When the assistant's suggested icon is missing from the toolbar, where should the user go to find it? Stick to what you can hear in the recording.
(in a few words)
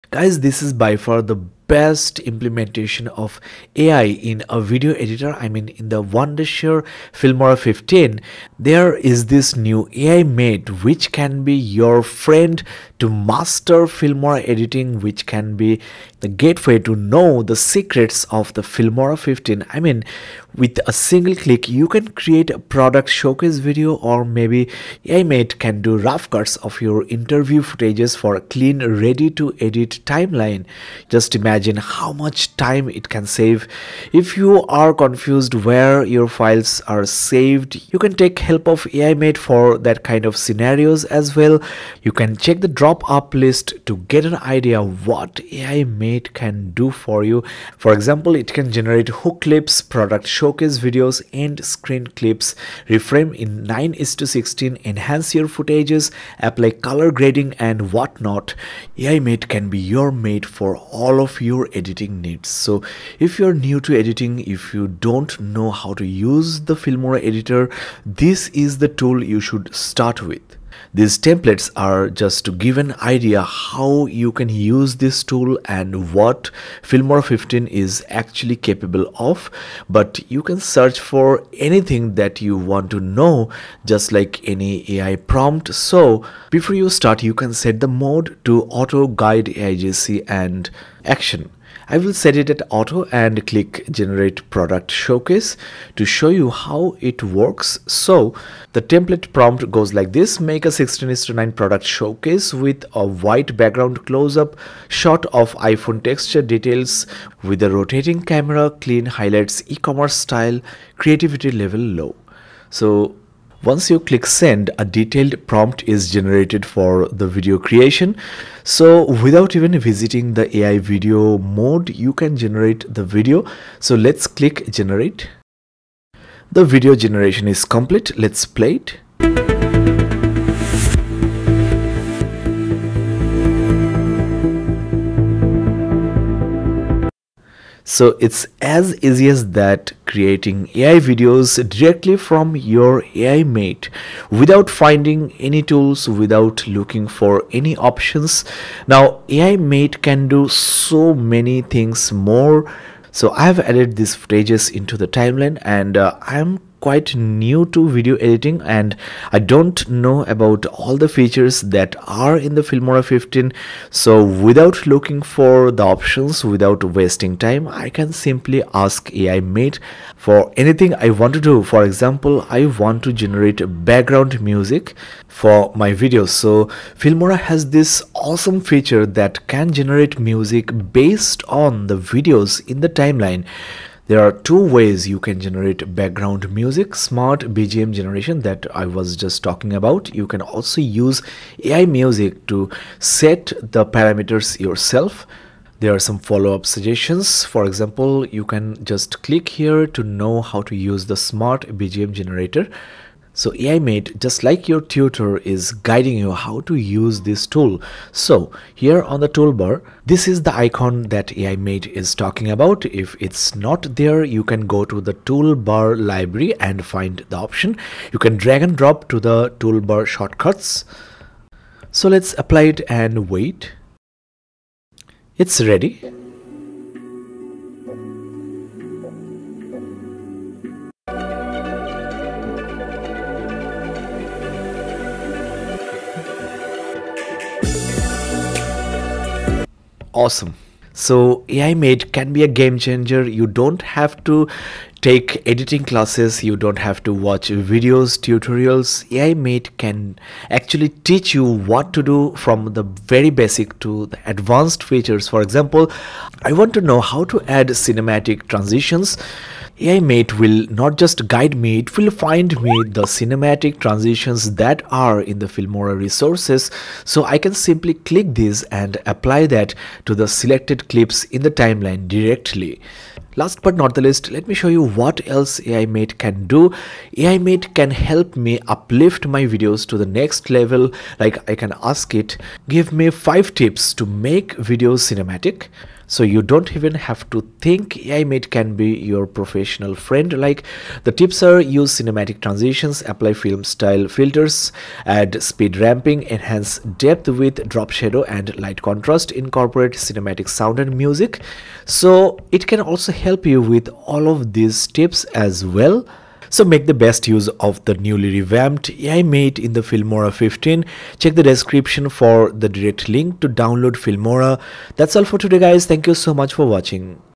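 Toolbar library.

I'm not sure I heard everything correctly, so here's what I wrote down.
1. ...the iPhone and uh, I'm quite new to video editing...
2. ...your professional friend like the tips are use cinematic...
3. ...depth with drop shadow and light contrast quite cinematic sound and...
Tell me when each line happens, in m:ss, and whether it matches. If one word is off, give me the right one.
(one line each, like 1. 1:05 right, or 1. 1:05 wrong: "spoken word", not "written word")
1. 2:34 wrong: "timeline", not "iPhone"
2. 4:49 right
3. 4:57 wrong: "incorporate", not "quite".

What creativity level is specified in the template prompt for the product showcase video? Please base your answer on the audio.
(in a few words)
Low.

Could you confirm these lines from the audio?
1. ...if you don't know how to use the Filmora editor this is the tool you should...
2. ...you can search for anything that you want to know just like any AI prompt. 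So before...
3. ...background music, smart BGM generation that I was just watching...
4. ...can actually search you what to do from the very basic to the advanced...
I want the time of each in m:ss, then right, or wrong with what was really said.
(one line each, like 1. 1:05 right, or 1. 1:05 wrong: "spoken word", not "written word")
1. 1:04 right
2. 1:20 right
3. 3:05 wrong: "talking", not "watching"
4. 4:09 wrong: "teach", not "search".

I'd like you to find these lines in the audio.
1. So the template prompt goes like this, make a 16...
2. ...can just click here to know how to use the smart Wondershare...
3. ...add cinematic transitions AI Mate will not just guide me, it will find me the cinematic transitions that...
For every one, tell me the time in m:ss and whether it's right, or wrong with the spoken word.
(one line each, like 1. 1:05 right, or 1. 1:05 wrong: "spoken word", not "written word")
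1. 1:37 right
2. 3:18 wrong: "BGM", not "Wondershare"
3. 4:17 right.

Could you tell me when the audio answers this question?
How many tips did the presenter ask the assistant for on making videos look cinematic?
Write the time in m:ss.
4:43.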